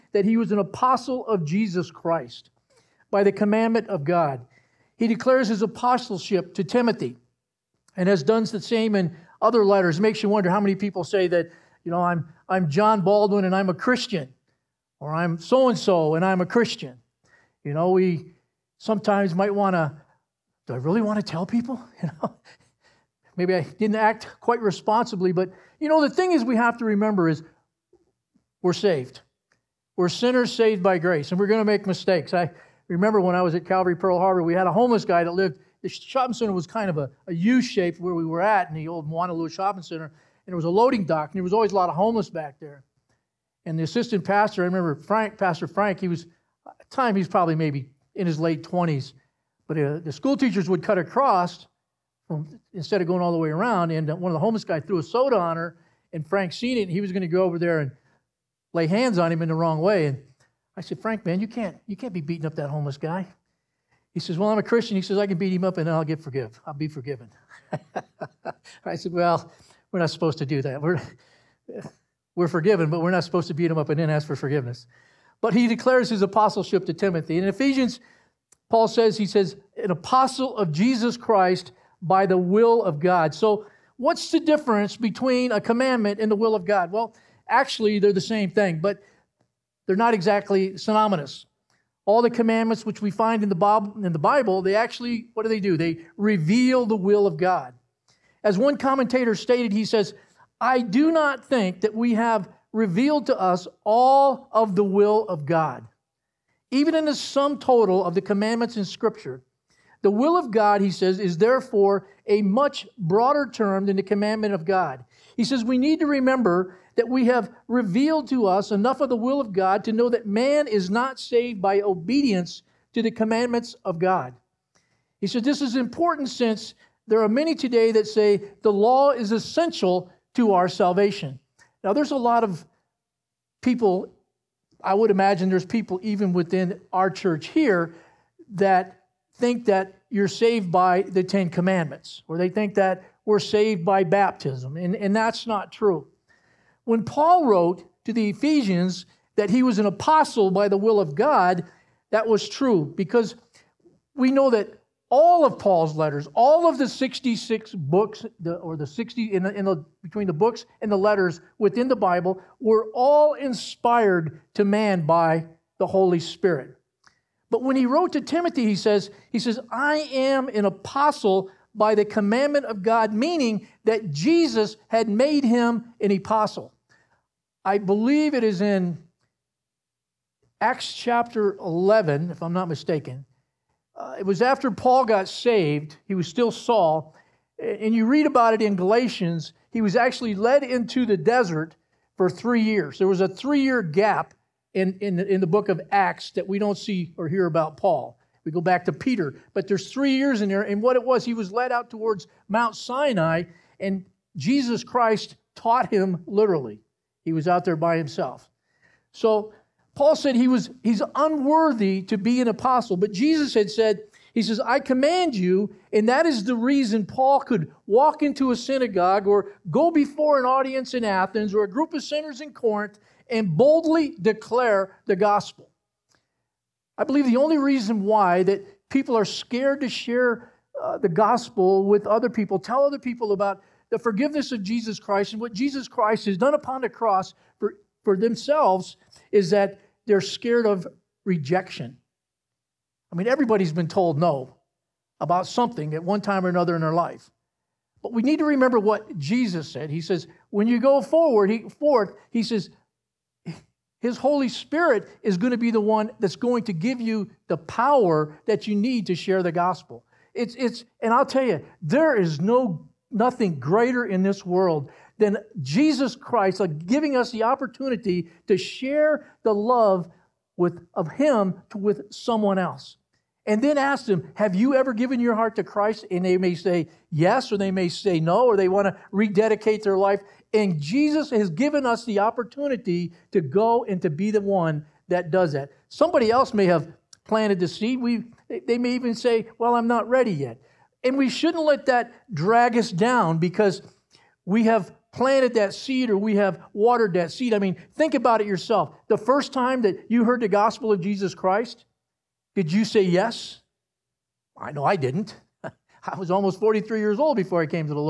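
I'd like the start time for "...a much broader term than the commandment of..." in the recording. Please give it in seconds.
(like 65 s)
112 s.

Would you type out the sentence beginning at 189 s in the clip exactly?
He was actually led into the desert for three years.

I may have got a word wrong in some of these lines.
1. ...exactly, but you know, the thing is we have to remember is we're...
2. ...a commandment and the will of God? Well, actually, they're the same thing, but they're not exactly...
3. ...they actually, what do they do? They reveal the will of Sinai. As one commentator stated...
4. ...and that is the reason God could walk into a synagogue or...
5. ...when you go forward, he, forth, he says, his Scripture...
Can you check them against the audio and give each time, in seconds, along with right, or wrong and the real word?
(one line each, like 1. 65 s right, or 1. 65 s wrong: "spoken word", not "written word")
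1. 24 s wrong: "responsibly", not "exactly"
2. 85 s right
3. 94 s wrong: "God", not "Sinai"
4. 215 s wrong: "Paul", not "God"
5. 250 s wrong: "Holy", not "Scripture".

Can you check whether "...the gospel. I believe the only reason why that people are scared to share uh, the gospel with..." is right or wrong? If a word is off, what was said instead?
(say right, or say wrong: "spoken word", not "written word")
right.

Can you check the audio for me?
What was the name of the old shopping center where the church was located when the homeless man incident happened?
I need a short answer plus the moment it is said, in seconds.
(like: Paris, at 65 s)
Moanalua Shopping Center, at 39 s.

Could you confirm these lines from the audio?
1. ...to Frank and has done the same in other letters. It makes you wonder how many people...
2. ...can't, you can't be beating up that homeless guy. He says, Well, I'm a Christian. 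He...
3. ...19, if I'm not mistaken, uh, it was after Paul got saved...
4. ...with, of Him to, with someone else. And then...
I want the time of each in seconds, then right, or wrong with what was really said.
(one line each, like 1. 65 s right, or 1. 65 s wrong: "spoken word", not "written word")
1. 6 s wrong: "Timothy", not "Frank"
2. 61 s right
3. 181 s wrong: "11", not "19"
4. 270 s right.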